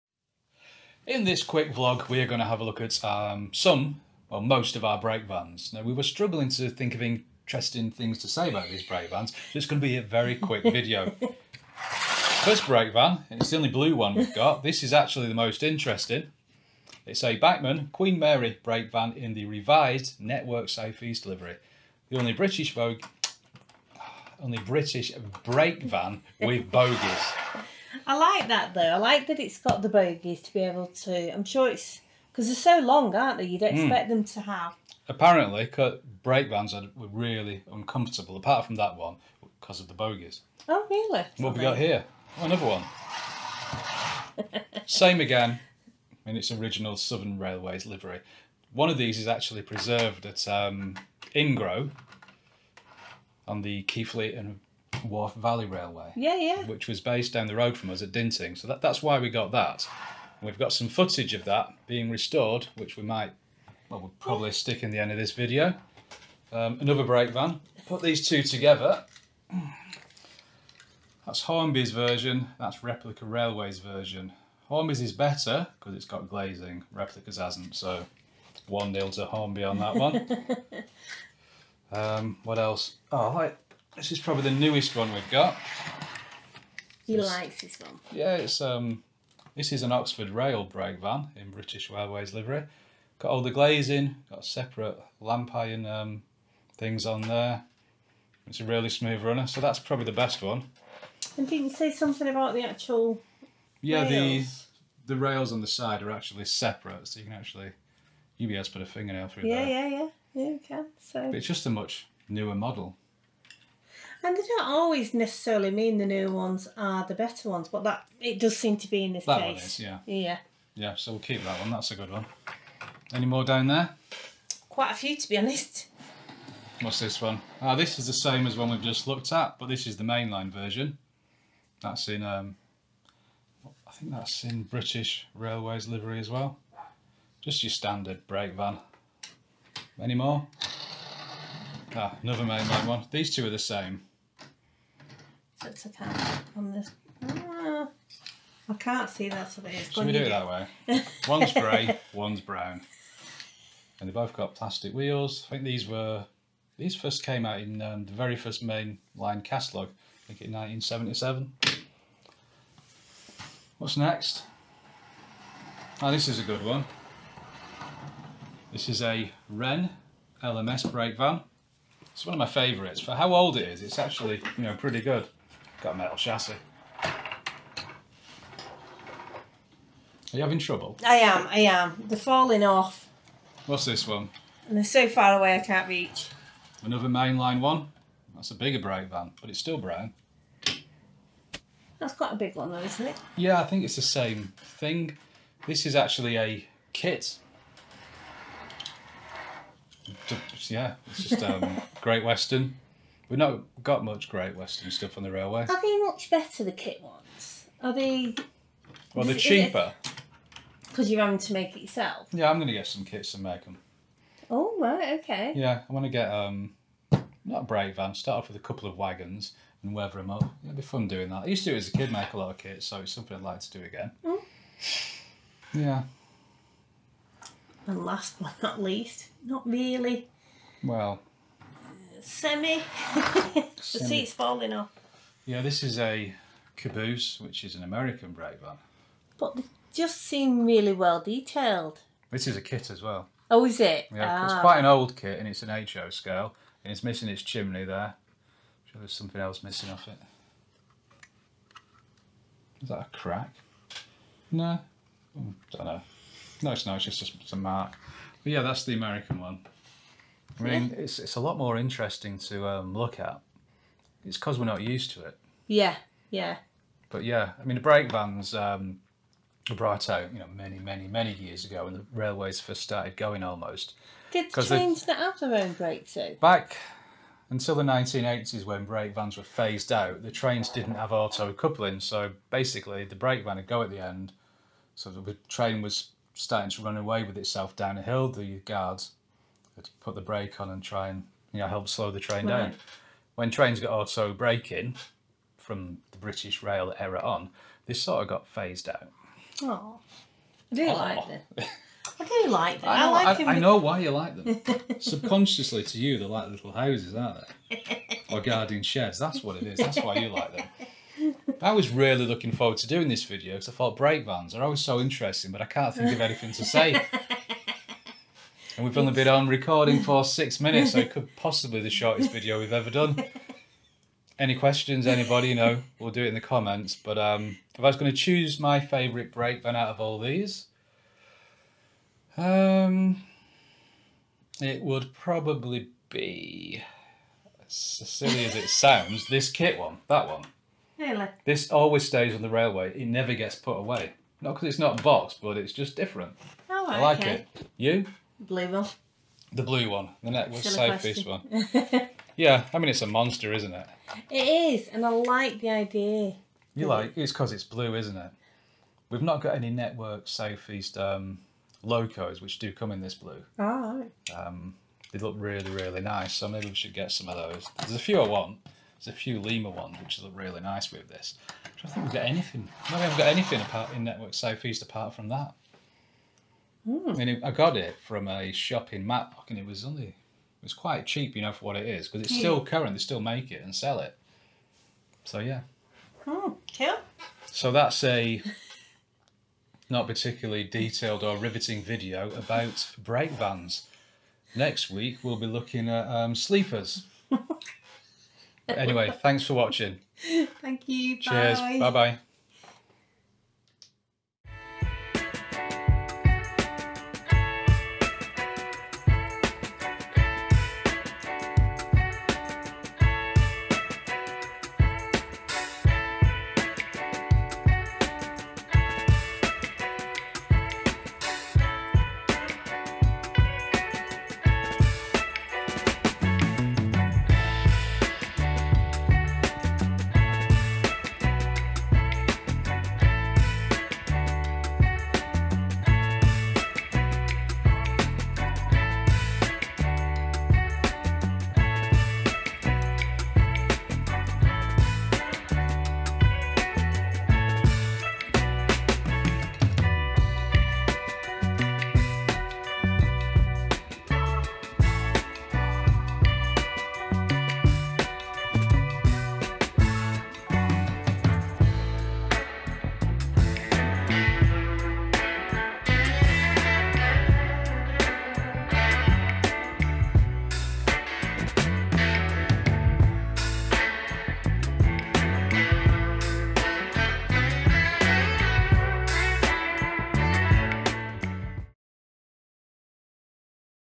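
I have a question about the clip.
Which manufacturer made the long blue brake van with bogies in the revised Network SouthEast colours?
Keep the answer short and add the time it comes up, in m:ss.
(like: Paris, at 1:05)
Bachmann, at 0:17.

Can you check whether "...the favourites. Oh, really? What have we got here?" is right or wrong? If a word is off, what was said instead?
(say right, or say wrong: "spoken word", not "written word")
wrong: "bogies", not "favourites".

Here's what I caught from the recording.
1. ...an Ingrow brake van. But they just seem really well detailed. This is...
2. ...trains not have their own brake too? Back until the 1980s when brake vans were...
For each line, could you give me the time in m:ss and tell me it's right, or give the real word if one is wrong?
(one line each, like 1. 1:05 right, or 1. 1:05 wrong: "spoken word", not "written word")
1. 3:57 wrong: "American", not "Ingrow"
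2. 4:34 right.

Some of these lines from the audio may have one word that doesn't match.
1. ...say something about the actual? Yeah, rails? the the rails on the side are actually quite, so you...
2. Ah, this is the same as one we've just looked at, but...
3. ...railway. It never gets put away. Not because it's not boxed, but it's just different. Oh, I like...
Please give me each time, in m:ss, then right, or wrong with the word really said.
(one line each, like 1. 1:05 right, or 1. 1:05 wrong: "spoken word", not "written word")
1. 1:41 wrong: "separate", not "quite"
2. 2:07 right
3. 5:42 right.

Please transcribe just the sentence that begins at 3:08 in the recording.
That's a bigger brake van, but it's still brown.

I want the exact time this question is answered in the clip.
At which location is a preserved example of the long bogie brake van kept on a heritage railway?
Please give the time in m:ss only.
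0:51.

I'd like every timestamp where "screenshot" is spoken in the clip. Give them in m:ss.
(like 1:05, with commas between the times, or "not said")
not said.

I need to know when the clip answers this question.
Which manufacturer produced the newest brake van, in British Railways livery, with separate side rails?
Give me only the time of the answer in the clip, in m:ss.
1:29.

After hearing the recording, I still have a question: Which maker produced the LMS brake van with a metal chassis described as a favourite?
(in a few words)
Wrenn.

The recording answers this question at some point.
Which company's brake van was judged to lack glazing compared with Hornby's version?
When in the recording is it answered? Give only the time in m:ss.
1:12.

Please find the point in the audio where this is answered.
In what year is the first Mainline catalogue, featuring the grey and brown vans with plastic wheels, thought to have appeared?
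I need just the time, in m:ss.
2:40.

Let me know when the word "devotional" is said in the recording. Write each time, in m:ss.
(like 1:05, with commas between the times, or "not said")
not said.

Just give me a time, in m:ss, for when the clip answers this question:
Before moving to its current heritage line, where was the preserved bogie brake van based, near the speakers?
0:58.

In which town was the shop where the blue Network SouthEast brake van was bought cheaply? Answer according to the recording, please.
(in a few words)
Matlock.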